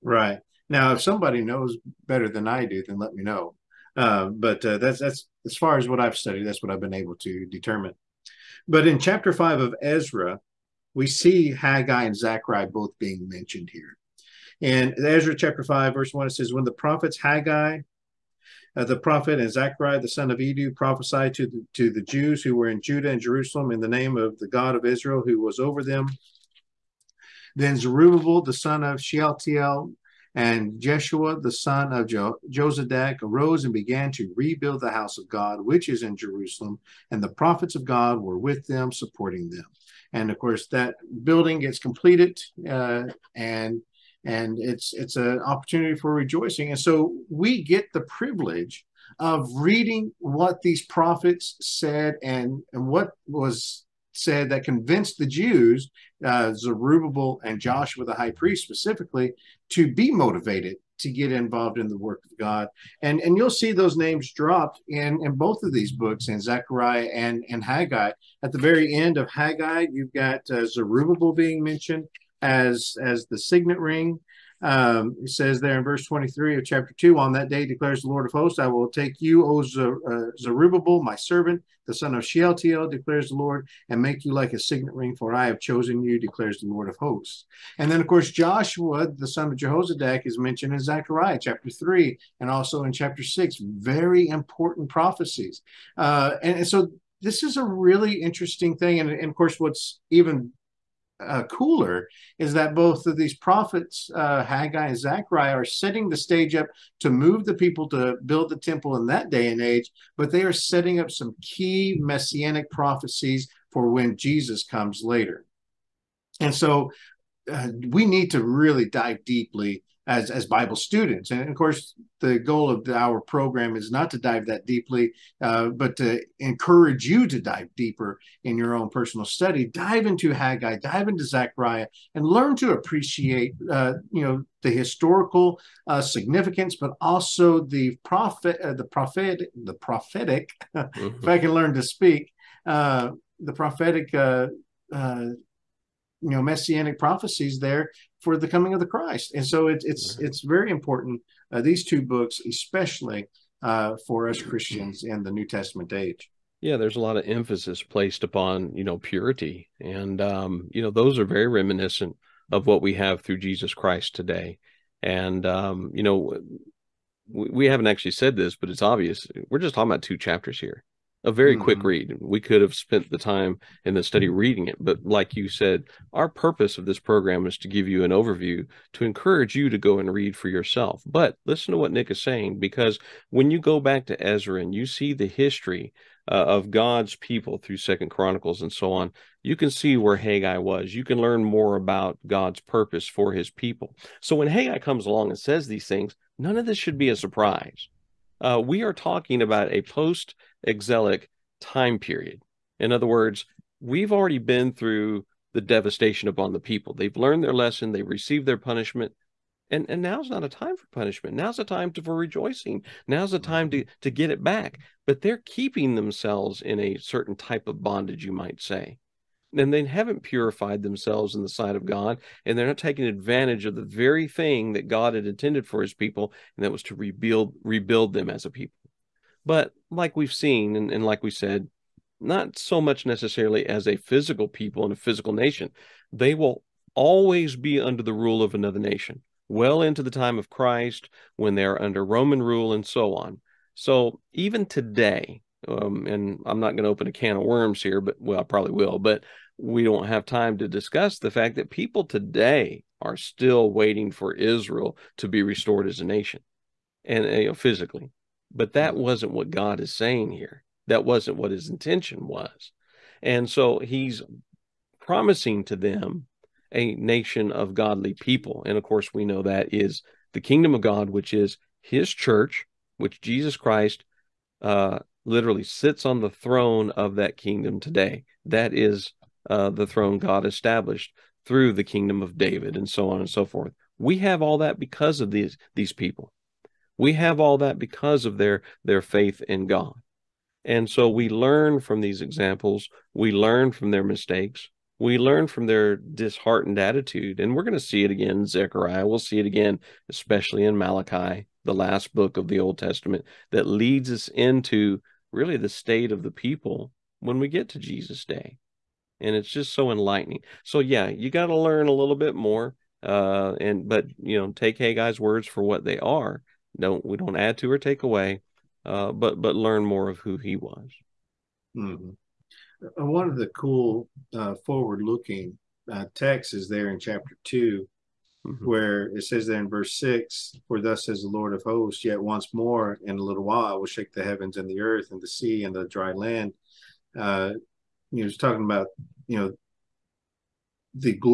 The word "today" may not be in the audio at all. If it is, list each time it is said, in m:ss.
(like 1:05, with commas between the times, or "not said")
2:44, 4:04, 4:12, 4:37.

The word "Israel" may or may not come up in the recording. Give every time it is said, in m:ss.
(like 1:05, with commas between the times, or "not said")
0:24, 4:14.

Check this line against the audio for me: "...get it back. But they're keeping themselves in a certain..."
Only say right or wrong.
right.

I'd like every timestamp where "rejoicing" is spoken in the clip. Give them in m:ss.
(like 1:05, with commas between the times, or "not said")
0:46, 3:32.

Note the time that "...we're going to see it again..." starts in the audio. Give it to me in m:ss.
4:57.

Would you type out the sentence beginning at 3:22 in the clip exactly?
In other words, we've already been through the devastation upon the people.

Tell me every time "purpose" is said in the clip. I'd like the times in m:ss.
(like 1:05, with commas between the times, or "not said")
2:56, 3:12.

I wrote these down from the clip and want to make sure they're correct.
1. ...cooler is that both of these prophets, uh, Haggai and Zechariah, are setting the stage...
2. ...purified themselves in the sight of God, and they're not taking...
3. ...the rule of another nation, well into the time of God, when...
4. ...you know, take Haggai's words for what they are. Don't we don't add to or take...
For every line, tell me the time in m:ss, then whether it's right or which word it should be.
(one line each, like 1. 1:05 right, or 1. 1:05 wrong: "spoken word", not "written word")
1. 1:41 right
2. 3:40 right
3. 3:58 wrong: "Christ", not "God"
4. 5:14 right.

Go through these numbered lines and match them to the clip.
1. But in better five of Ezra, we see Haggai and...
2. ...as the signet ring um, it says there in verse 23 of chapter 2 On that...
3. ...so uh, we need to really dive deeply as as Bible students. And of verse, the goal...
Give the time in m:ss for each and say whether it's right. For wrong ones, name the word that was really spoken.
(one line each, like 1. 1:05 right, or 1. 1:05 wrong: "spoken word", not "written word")
1. 0:08 wrong: "chapter", not "better"
2. 1:13 right
3. 1:56 wrong: "course", not "verse".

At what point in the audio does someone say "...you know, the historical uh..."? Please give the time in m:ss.
2:14.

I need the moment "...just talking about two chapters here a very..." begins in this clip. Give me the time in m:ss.
2:49.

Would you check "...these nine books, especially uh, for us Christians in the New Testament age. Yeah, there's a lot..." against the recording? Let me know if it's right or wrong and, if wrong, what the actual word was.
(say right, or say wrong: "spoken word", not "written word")
wrong: "two", not "nine".